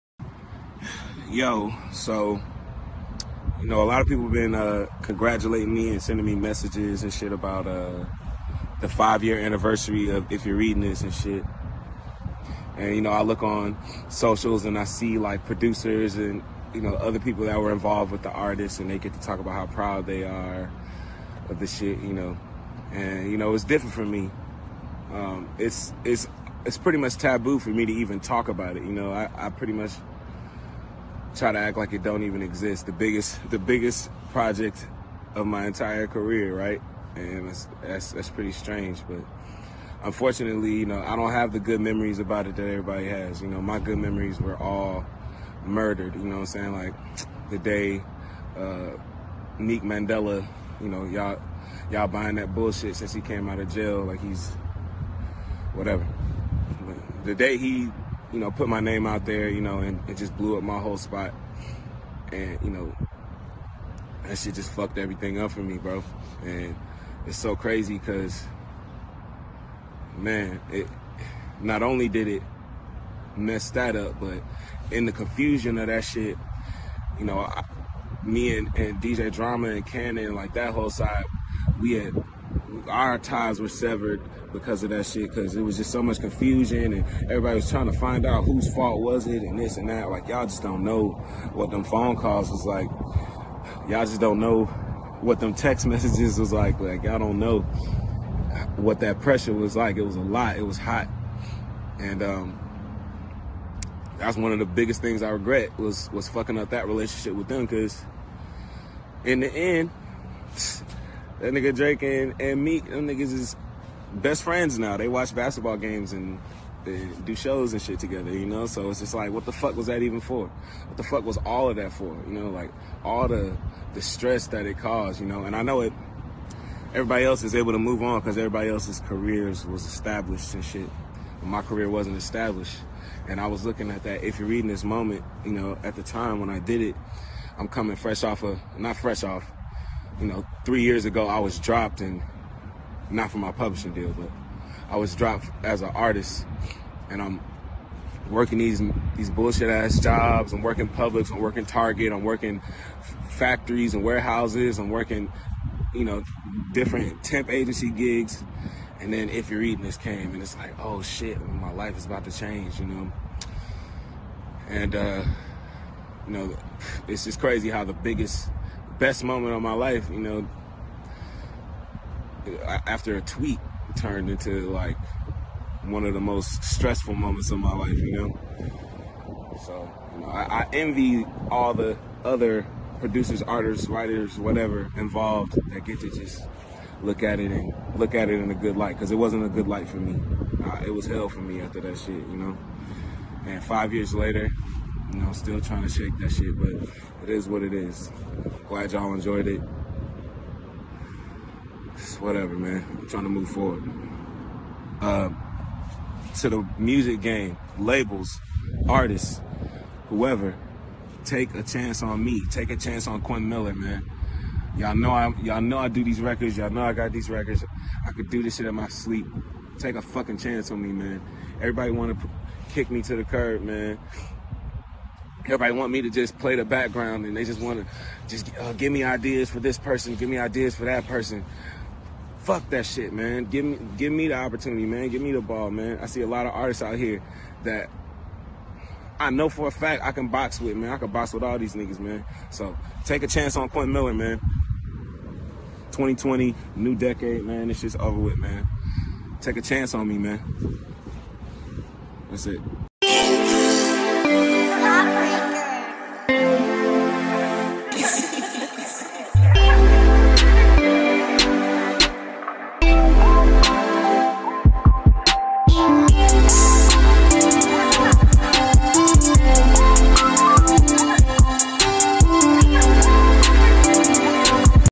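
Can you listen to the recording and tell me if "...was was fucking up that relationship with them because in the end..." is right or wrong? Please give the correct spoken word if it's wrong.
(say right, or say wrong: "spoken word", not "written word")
right.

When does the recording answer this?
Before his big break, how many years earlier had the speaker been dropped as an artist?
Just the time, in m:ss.
2:20.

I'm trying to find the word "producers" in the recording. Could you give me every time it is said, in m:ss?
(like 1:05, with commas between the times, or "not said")
0:15, 3:02.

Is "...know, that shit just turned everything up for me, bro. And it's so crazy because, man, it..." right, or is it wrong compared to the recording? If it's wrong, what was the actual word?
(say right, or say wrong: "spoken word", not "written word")
wrong: "fucked", not "turned".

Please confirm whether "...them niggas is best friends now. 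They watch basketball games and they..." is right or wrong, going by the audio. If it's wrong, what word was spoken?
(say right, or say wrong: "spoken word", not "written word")
right.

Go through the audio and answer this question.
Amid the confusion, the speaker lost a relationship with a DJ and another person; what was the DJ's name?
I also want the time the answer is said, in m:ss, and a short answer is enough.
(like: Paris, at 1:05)
DJ Drama, at 1:19.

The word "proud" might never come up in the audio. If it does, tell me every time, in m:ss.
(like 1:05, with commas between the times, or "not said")
0:19.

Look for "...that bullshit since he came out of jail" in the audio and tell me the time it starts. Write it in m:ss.
0:52.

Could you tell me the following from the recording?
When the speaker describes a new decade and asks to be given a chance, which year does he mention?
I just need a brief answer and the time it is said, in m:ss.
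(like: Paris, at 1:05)
2020, at 4:05.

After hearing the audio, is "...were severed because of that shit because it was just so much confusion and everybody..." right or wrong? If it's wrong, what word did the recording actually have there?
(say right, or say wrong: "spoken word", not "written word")
right.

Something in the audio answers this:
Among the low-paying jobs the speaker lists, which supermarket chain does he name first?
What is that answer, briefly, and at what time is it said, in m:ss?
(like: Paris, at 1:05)
Publix, at 2:30.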